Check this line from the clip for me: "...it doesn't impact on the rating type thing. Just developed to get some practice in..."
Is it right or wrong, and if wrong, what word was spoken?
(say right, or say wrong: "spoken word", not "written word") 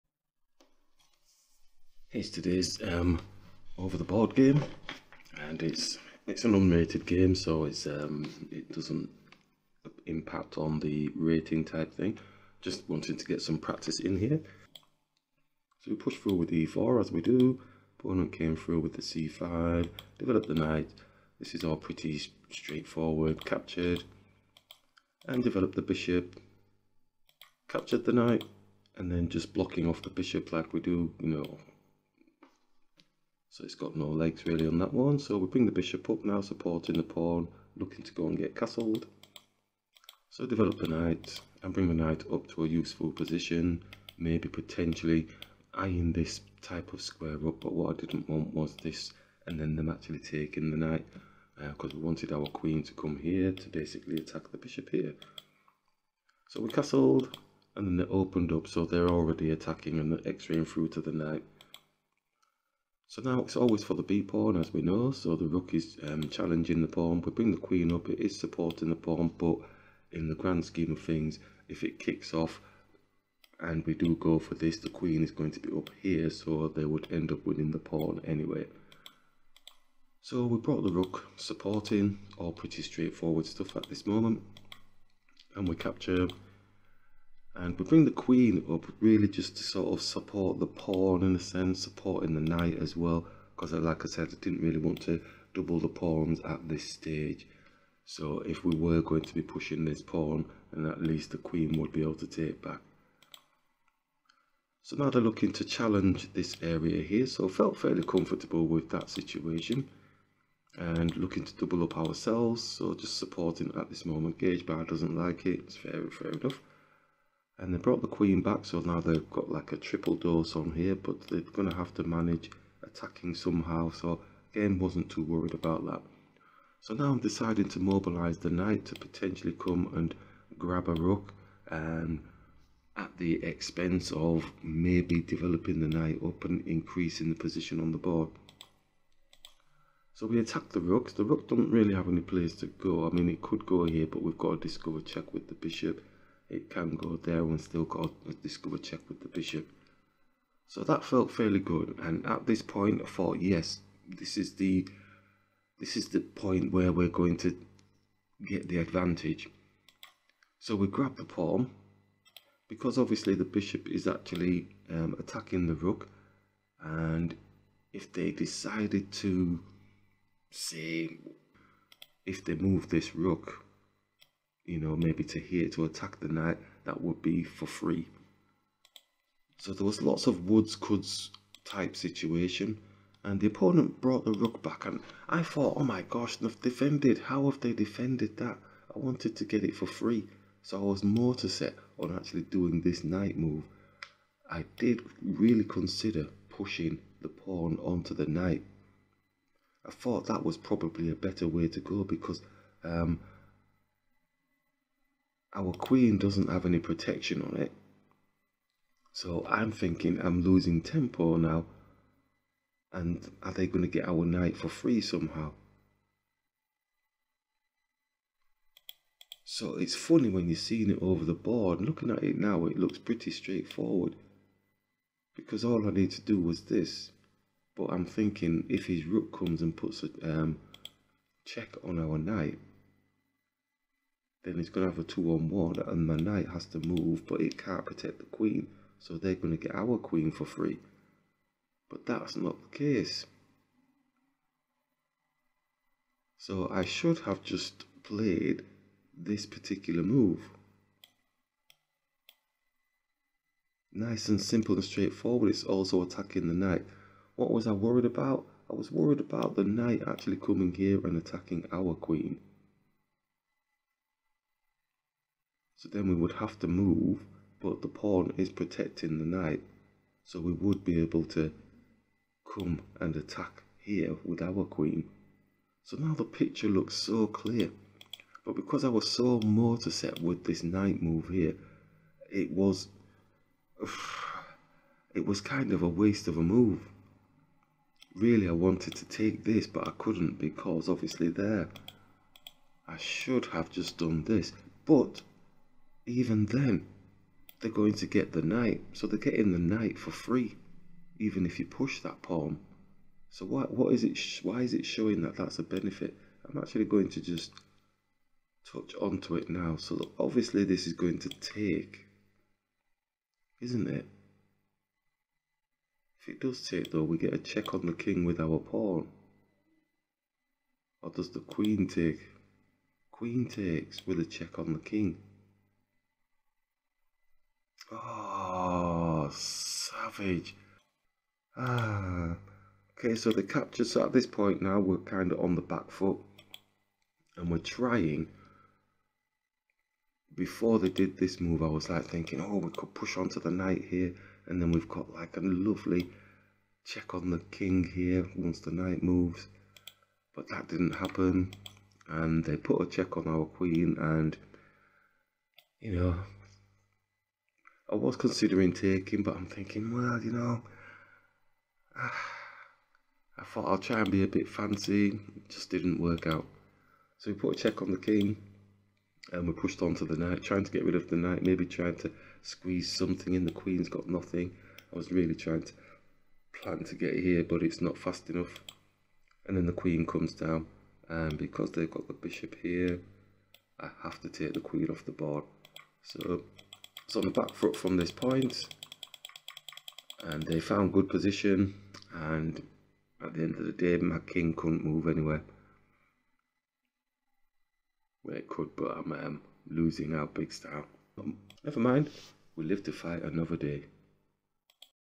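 wrong: "wanted", not "developed".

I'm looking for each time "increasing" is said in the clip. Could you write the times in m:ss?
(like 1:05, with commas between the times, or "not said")
2:16.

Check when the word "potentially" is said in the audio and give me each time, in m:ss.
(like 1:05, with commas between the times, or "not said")
0:44, 2:08.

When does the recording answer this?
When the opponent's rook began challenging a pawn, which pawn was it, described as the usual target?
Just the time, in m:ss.
1:04.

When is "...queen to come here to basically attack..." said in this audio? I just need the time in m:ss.
0:52.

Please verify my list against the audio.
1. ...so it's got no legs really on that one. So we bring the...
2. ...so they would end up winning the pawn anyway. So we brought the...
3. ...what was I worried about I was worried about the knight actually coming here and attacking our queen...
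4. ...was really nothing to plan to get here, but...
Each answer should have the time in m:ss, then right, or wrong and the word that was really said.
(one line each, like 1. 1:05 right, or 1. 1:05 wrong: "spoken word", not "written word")
1. 0:33 right
2. 1:16 right
3. 4:17 right
4. 6:14 wrong: "trying", not "nothing".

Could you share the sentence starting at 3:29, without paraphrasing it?
So I'm thinking I'm losing tempo now.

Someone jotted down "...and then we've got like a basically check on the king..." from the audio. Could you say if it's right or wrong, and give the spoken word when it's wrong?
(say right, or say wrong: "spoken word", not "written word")
wrong: "lovely", not "basically".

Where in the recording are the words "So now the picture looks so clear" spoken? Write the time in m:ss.
4:35.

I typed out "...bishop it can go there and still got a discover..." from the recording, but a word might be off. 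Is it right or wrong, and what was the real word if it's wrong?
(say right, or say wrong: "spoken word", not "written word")
right.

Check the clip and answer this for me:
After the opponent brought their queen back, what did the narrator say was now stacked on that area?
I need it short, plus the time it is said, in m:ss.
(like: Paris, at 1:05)
A triple dose, at 1:59.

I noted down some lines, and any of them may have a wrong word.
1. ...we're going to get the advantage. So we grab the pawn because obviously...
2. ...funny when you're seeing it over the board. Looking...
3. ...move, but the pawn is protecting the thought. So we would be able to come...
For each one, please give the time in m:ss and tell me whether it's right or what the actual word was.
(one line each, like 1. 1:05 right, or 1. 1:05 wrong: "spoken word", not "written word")
1. 2:36 right
2. 3:39 right
3. 4:26 wrong: "knight", not "thought".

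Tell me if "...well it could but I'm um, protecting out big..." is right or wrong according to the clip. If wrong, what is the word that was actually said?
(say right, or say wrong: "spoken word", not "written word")
wrong: "losing", not "protecting".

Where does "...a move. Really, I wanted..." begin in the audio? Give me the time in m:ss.
4:46.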